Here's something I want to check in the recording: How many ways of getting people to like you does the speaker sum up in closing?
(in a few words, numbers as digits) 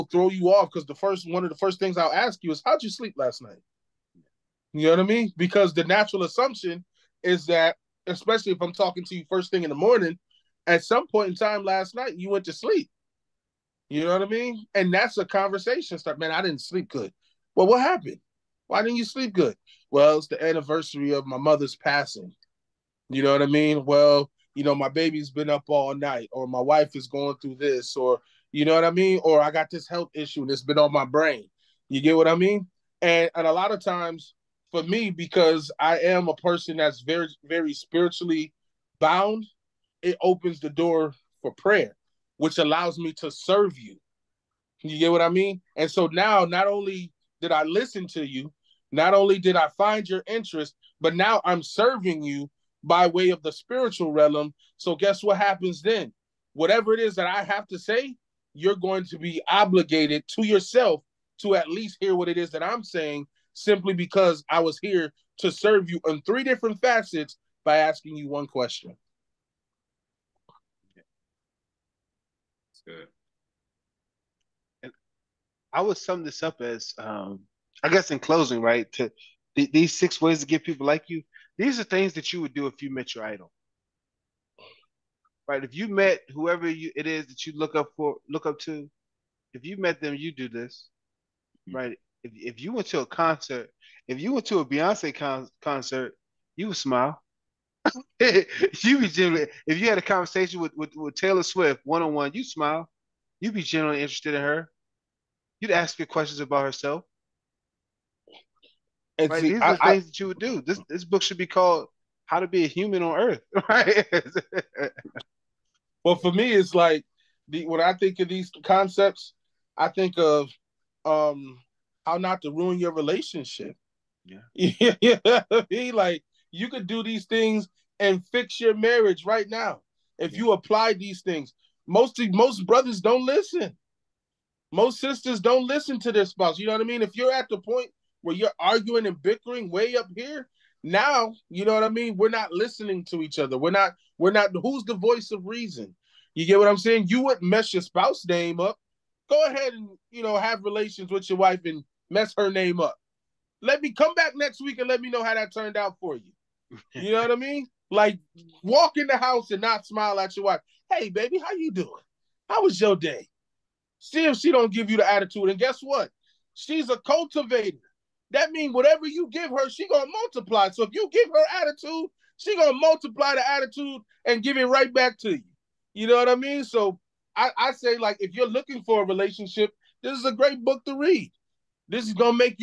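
6.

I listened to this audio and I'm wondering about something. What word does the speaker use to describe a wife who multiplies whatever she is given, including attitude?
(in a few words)
Cultivator.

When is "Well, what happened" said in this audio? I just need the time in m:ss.
0:17.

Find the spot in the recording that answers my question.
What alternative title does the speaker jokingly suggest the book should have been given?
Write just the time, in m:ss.
1:52.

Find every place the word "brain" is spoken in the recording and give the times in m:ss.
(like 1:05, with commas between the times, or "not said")
0:31.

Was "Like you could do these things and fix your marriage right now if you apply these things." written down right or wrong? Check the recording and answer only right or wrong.
right.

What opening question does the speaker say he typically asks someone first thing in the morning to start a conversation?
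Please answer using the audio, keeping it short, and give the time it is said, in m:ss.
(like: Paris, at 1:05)
How'd you sleep last night?, at 0:02.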